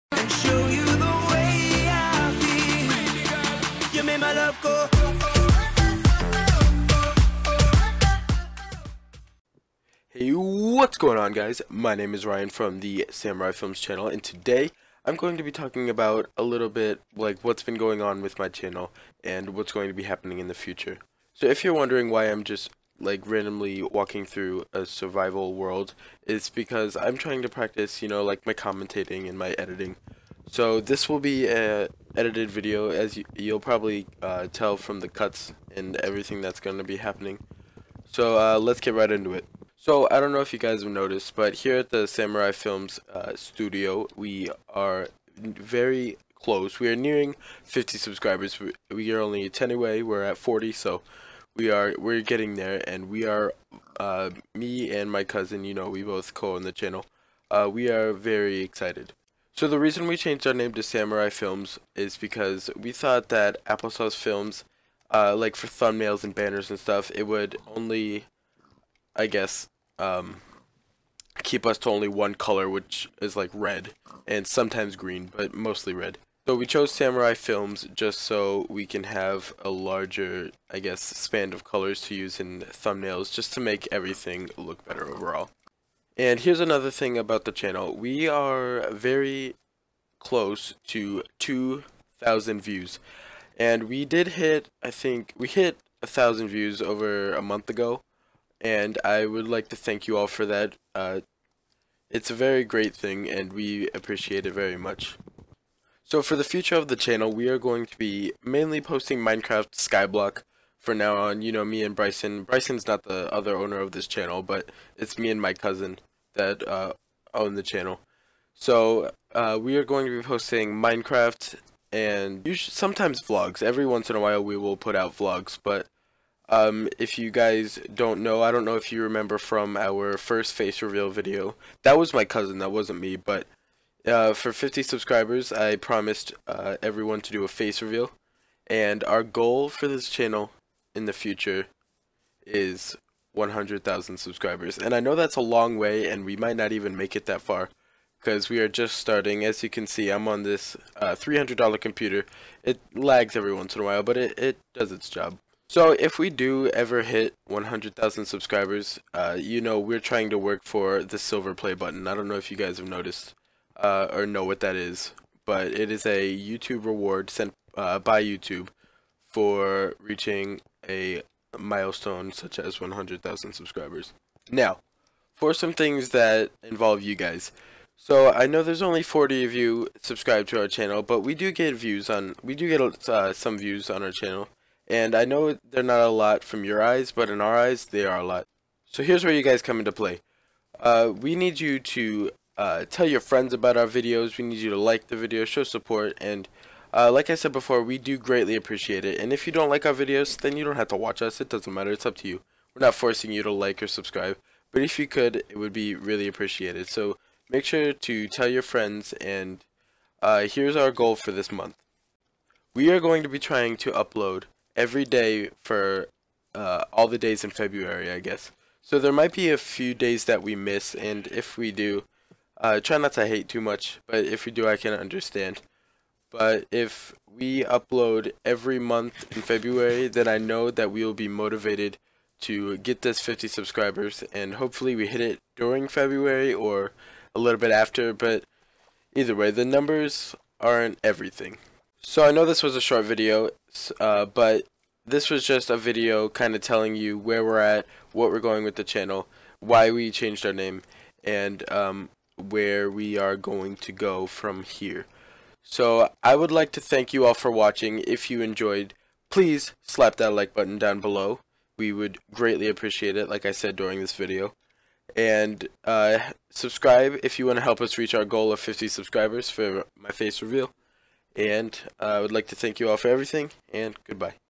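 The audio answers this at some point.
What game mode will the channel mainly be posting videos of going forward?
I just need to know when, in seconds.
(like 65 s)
109 s.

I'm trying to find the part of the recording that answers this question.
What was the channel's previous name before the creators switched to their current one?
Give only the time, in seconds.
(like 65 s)
63 s.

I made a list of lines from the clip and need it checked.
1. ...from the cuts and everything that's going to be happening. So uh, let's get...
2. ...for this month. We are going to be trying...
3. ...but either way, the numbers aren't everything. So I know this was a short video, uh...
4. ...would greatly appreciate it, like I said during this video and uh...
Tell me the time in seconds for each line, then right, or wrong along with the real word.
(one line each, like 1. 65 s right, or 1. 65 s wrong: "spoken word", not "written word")
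1. 34 s right
2. 211 s right
3. 238 s right
4. 261 s right.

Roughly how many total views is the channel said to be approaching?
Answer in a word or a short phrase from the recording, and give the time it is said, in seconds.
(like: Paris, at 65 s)
2,000, at 91 s.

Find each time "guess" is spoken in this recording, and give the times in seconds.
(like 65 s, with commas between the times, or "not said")
69 s, 80 s, 218 s.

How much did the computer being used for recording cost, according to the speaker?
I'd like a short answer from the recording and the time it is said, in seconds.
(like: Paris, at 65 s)
$300, at 151 s.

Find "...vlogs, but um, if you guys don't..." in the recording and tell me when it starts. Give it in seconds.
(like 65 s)
125 s.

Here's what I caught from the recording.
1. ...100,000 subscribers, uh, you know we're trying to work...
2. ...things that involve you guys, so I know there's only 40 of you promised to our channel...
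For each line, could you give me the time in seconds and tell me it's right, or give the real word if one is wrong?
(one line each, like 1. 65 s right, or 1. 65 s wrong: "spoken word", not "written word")
1. 157 s right
2. 175 s wrong: "subscribed", not "promised".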